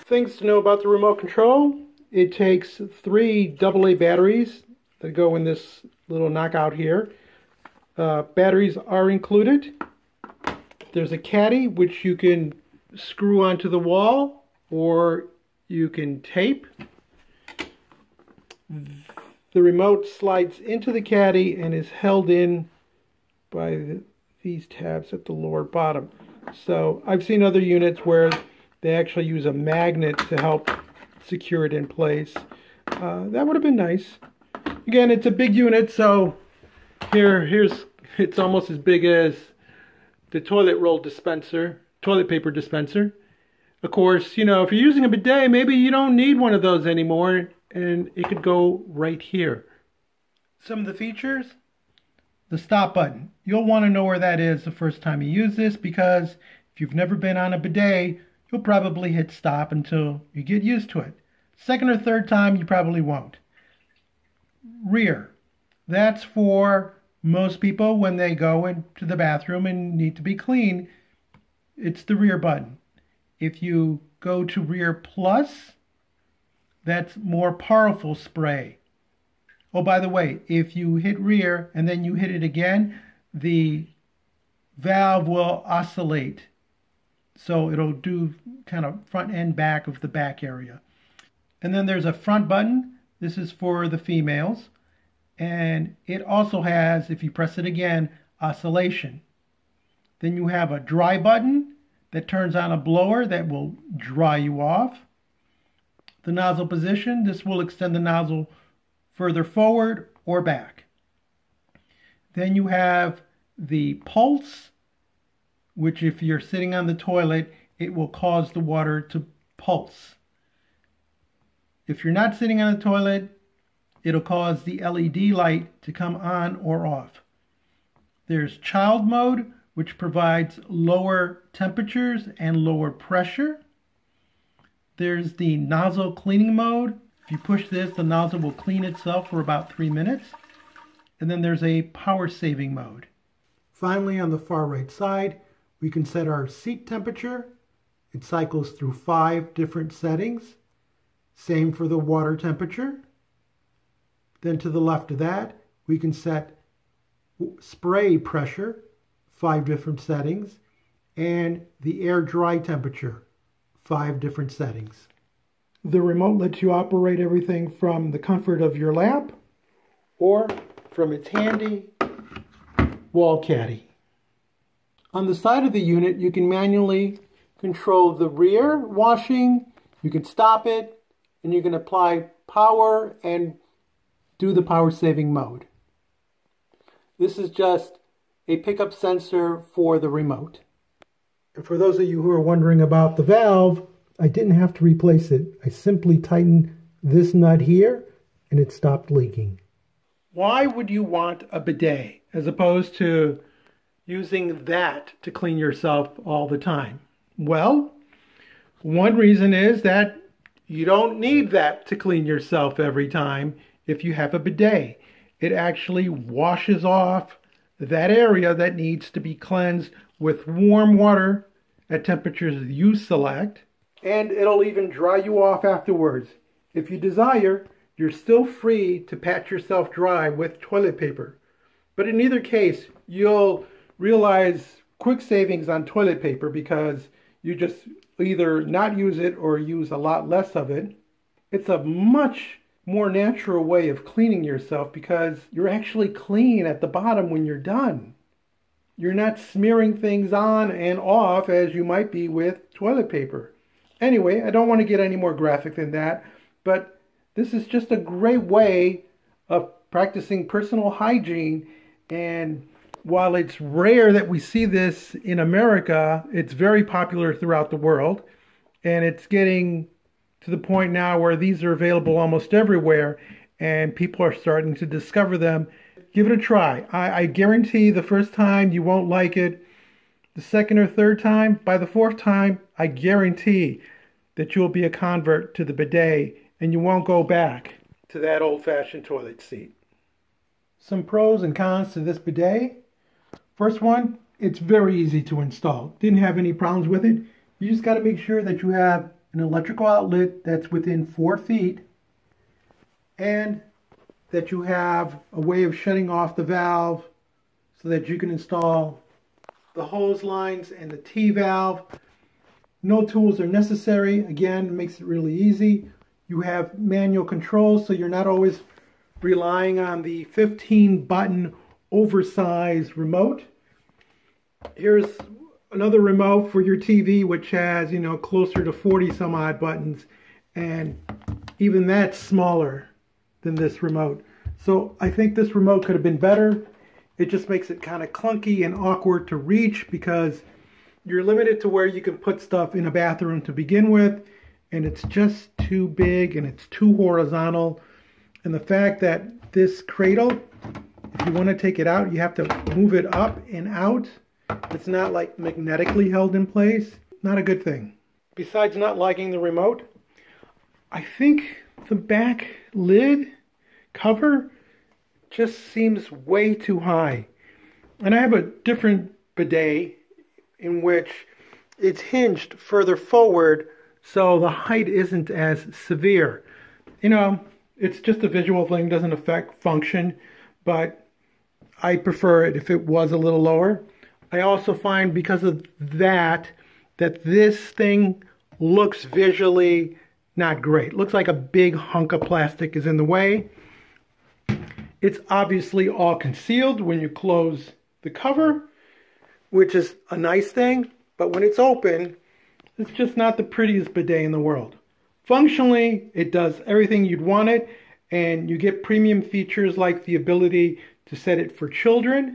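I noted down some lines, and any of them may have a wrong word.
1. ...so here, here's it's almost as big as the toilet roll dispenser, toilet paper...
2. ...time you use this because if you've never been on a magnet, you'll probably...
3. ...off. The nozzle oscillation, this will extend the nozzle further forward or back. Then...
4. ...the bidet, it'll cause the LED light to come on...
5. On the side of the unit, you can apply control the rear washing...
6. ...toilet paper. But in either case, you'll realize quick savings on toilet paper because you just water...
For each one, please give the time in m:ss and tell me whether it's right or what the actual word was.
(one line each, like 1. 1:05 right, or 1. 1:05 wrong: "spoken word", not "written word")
1. 0:35 right
2. 0:55 wrong: "bidet", not "magnet"
3. 1:44 wrong: "position", not "oscillation"
4. 2:02 wrong: "toilet", not "bidet"
5. 2:55 wrong: "manually", not "apply"
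6. 3:50 wrong: "either", not "water".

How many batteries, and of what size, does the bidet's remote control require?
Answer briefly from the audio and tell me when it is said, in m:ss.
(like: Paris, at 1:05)
3 AA, at 0:03.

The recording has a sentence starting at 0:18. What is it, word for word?
The remote slides into the caddy and is held in by the, these tabs at the lower bottom.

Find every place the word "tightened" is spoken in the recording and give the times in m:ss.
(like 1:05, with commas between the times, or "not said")
3:16.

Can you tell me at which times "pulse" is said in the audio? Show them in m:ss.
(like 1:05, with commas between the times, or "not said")
1:54, 1:59.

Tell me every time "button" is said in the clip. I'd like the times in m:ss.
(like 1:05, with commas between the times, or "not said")
0:52, 1:12, 1:32, 1:41, 5:21, 5:29.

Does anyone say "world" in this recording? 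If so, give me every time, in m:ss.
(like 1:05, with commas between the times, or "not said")
4:27, 6:44.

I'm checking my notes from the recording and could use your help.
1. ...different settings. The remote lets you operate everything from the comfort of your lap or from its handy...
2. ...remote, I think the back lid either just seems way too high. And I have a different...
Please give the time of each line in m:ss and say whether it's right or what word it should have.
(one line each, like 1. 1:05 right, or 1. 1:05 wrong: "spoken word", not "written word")
1. 2:44 right
2. 5:59 wrong: "cover", not "either".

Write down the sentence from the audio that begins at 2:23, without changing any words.
Finally, on the far right side, we can set our seat temperature.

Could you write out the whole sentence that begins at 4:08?
You're not smearing things on and off as you might be with toilet paper.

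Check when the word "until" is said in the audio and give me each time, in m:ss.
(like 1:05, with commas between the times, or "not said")
0:59.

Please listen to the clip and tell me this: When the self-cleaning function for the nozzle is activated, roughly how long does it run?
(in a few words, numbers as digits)
3 minutes.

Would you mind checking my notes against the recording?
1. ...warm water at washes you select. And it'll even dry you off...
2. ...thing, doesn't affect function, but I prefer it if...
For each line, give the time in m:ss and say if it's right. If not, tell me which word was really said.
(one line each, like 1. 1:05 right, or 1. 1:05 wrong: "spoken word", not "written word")
1. 3:40 wrong: "temperatures", not "washes"
2. 6:18 right.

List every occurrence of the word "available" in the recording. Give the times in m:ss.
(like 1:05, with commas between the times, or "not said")
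4:31.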